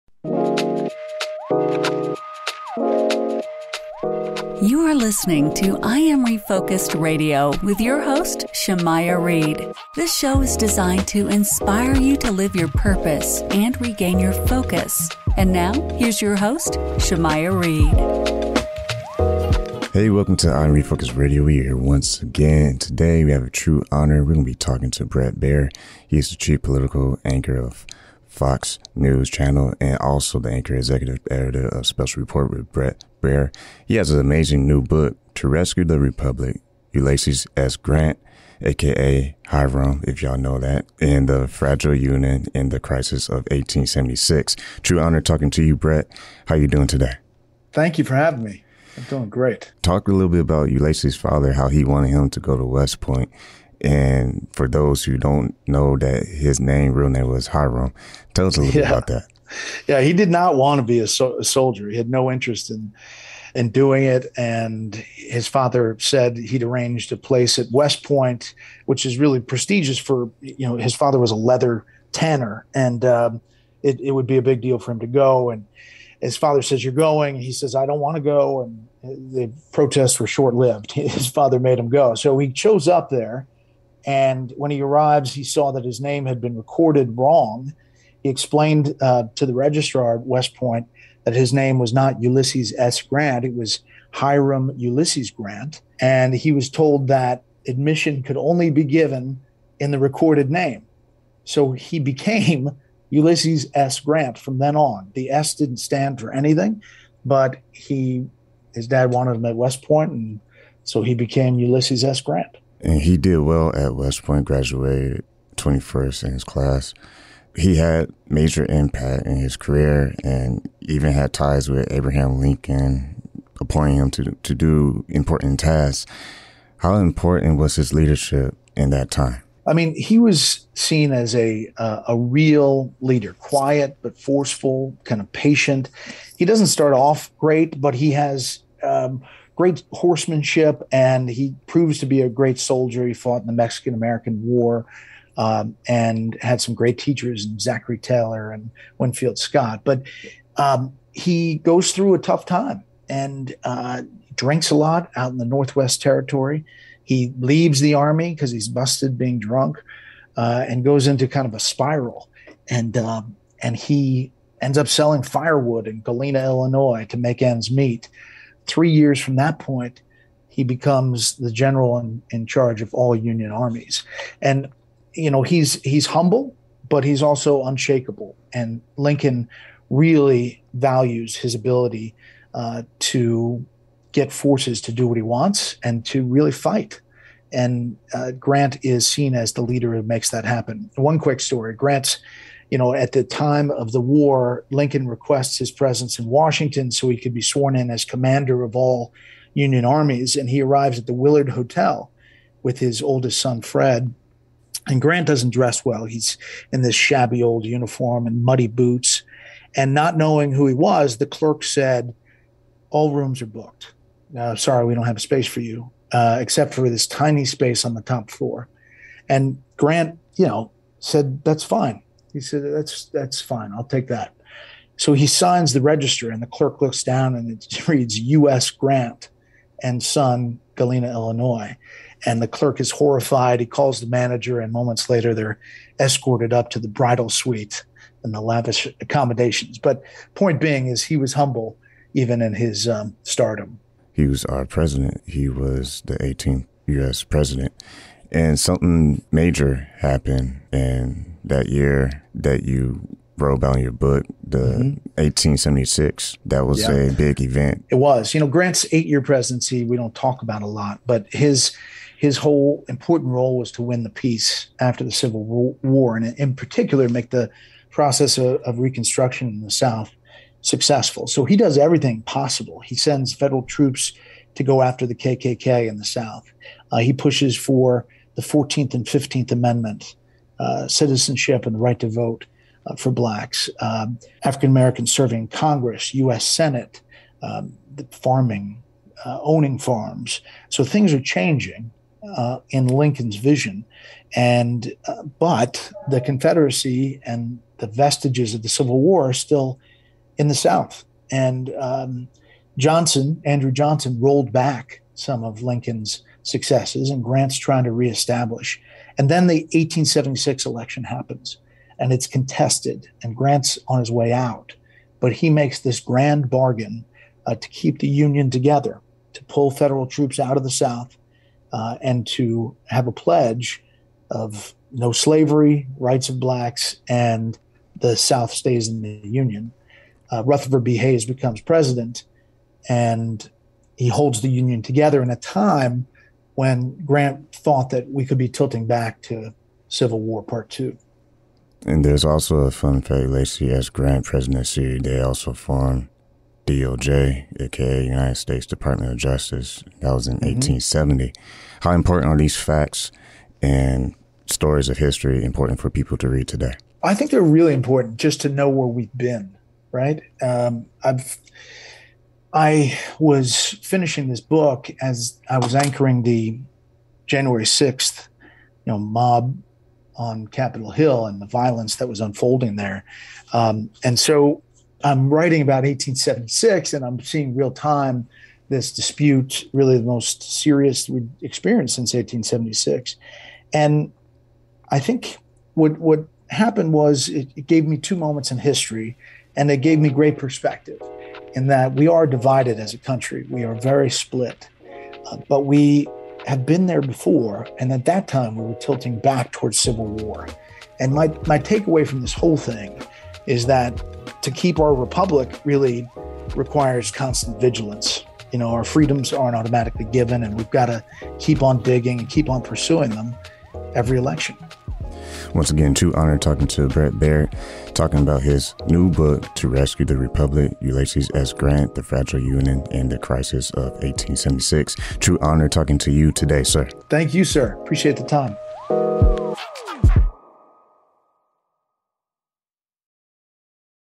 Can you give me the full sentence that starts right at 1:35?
And he was told that admission could only be given in the recorded name.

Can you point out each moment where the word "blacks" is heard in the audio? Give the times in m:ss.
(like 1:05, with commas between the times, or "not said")
4:43, 5:26.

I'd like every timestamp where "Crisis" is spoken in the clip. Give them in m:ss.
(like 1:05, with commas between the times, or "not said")
0:42, 7:03.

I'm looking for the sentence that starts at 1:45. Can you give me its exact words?
The S didn't stand for anything, but he his dad wanted him at West Point, and so he became Ulysses S.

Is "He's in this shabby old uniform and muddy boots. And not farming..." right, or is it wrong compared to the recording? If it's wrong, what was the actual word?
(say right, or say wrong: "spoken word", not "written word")
wrong: "knowing", not "farming".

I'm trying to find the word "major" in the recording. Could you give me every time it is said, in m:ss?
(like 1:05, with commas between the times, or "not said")
1:58, 4:09.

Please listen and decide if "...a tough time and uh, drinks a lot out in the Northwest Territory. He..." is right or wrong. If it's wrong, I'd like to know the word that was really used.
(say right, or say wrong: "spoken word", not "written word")
right.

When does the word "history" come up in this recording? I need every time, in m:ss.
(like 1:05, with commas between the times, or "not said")
5:54, 6:28.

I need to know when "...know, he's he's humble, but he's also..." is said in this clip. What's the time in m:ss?
2:55.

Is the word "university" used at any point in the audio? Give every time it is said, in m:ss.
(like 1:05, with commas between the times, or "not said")
not said.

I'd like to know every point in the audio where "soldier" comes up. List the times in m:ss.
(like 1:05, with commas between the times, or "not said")
1:01, 2:22.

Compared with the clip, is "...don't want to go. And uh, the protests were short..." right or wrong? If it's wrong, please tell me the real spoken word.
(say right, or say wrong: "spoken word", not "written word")
right.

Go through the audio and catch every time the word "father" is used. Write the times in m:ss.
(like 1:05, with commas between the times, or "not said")
0:51, 1:05, 1:10, 1:16, 1:21.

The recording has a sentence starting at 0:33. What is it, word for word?
He has an amazing new book, To Rescue the Republic, Ulysses S.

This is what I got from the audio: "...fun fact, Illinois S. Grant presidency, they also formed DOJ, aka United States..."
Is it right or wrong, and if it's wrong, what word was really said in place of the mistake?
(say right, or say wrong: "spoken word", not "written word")
wrong: "Ulysses", not "Illinois".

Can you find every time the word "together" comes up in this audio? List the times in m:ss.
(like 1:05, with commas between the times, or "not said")
5:18, 5:34.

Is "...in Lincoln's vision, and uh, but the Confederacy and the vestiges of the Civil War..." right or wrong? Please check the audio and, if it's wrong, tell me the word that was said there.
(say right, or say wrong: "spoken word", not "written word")
right.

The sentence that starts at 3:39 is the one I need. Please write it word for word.
And Grant, you know, said, That's fine.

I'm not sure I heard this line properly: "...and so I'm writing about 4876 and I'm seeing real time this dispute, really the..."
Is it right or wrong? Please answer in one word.
wrong.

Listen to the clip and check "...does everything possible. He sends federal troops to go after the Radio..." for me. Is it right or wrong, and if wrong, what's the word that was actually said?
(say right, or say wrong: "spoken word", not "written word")
wrong: "KKK", not "Radio".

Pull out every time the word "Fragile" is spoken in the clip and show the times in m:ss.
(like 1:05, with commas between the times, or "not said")
0:41, 7:02.